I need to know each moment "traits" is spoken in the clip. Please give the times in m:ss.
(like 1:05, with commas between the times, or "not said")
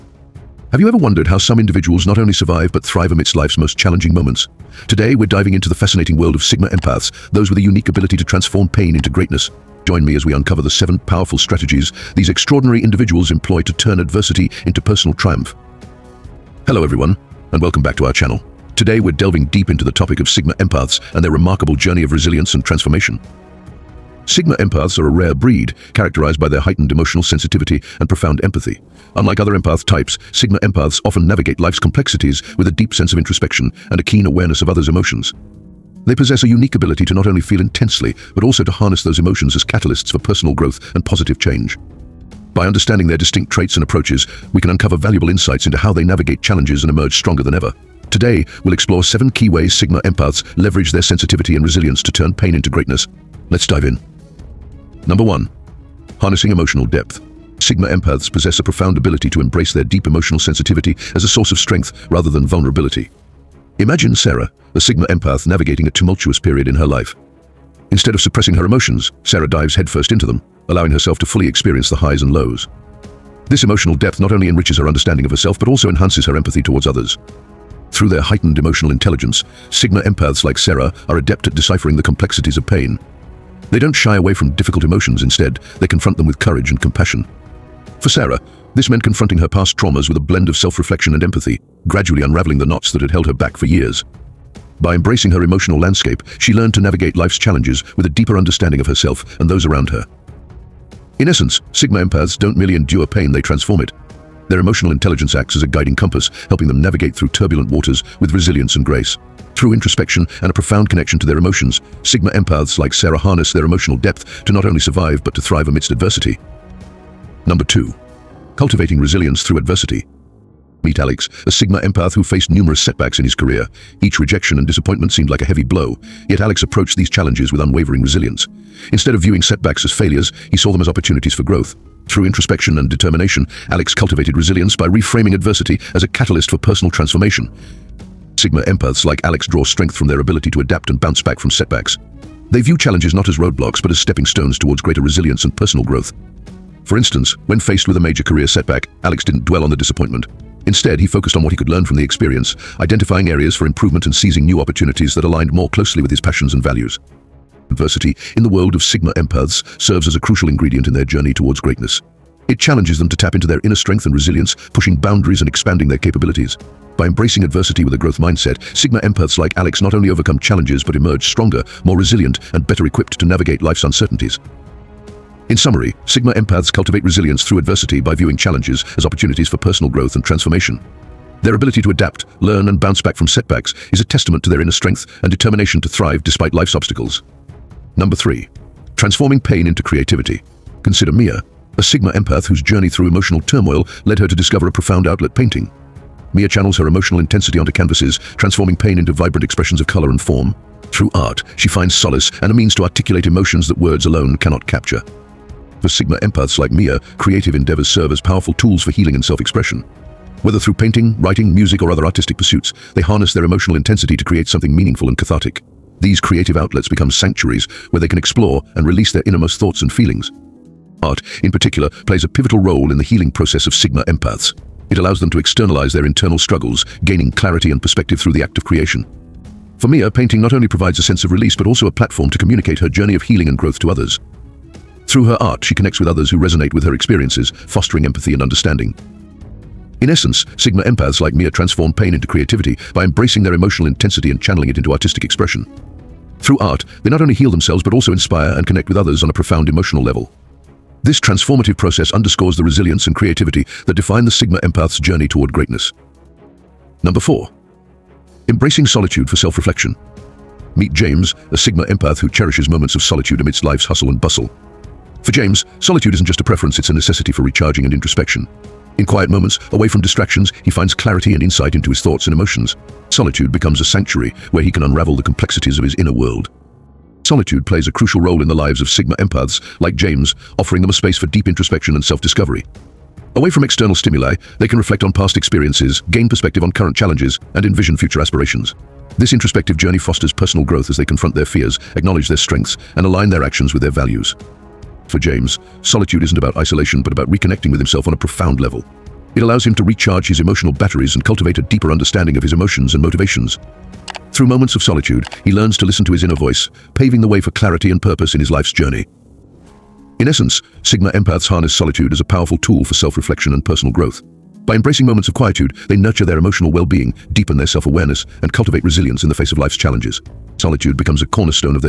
0:43.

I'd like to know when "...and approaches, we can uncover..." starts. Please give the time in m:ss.
0:43.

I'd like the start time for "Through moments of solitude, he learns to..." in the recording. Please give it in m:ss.
5:04.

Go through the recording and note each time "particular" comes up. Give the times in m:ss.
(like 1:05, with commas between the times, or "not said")
3:41.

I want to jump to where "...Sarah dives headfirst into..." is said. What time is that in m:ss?
1:09.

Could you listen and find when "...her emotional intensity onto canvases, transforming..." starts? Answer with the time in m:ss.
3:16.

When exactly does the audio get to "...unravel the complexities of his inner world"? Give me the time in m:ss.
4:34.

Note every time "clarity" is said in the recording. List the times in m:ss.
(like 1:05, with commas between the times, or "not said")
3:47, 4:30, 5:07.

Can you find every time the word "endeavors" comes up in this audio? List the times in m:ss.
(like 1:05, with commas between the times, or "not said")
3:27.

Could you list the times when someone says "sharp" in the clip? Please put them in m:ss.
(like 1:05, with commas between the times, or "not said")
not said.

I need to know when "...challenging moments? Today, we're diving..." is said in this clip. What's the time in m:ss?
0:03.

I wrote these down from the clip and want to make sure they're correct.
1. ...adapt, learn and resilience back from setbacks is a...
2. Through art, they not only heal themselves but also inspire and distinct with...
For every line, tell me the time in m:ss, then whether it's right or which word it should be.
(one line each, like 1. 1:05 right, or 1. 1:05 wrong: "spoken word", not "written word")
1. 3:01 wrong: "bounce", not "resilience"
2. 4:06 wrong: "connect", not "distinct".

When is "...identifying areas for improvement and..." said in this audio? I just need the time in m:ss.
2:32.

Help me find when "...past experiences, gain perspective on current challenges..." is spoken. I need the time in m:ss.
4:45.